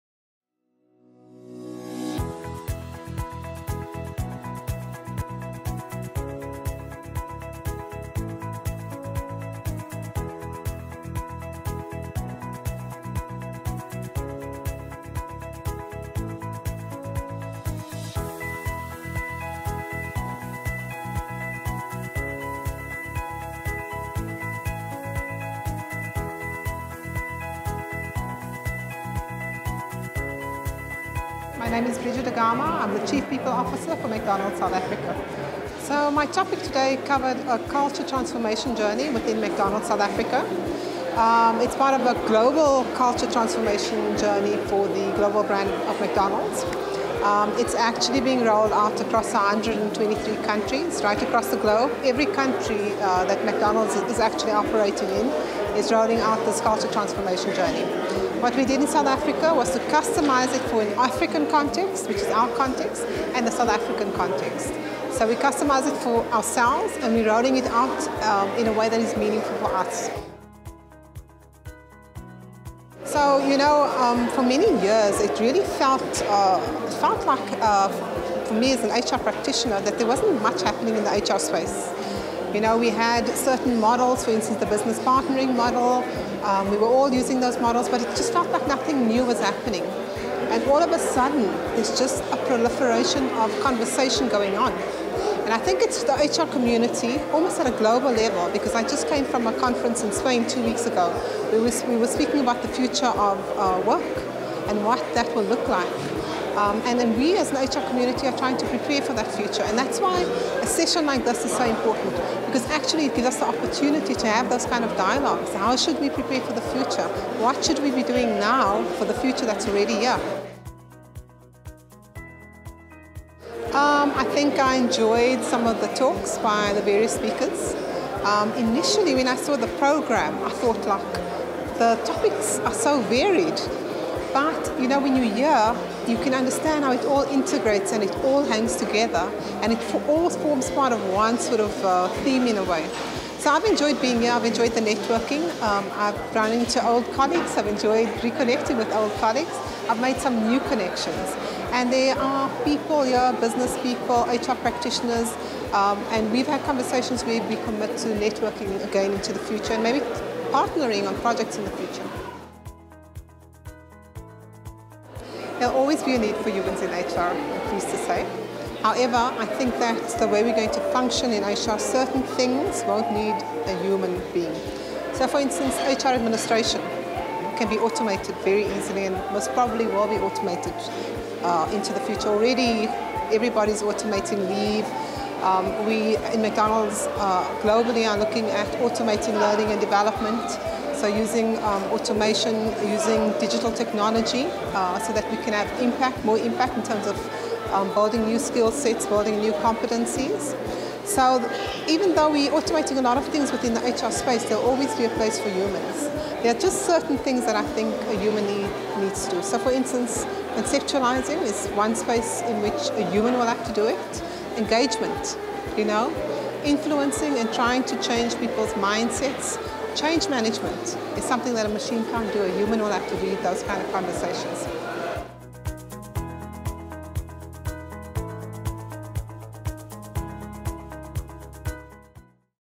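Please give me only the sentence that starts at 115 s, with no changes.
How should we prepare for the future?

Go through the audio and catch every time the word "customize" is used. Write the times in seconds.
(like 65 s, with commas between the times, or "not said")
59 s, 65 s.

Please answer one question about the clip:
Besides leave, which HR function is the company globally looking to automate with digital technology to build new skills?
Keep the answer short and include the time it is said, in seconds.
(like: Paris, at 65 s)
learning and development, at 189 s.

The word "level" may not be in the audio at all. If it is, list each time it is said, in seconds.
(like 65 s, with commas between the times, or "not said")
98 s.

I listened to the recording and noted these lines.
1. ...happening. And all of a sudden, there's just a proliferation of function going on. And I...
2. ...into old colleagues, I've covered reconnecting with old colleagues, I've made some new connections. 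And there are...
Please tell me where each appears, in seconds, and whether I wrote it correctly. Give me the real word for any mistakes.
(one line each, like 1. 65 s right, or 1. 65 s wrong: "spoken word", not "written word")
1. 89 s wrong: "conversation", not "function"
2. 146 s wrong: "enjoyed", not "covered".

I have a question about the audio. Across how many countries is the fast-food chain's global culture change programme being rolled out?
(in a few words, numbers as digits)
123.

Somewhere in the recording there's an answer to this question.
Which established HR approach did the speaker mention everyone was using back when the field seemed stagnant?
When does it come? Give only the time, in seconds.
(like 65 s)
84 s.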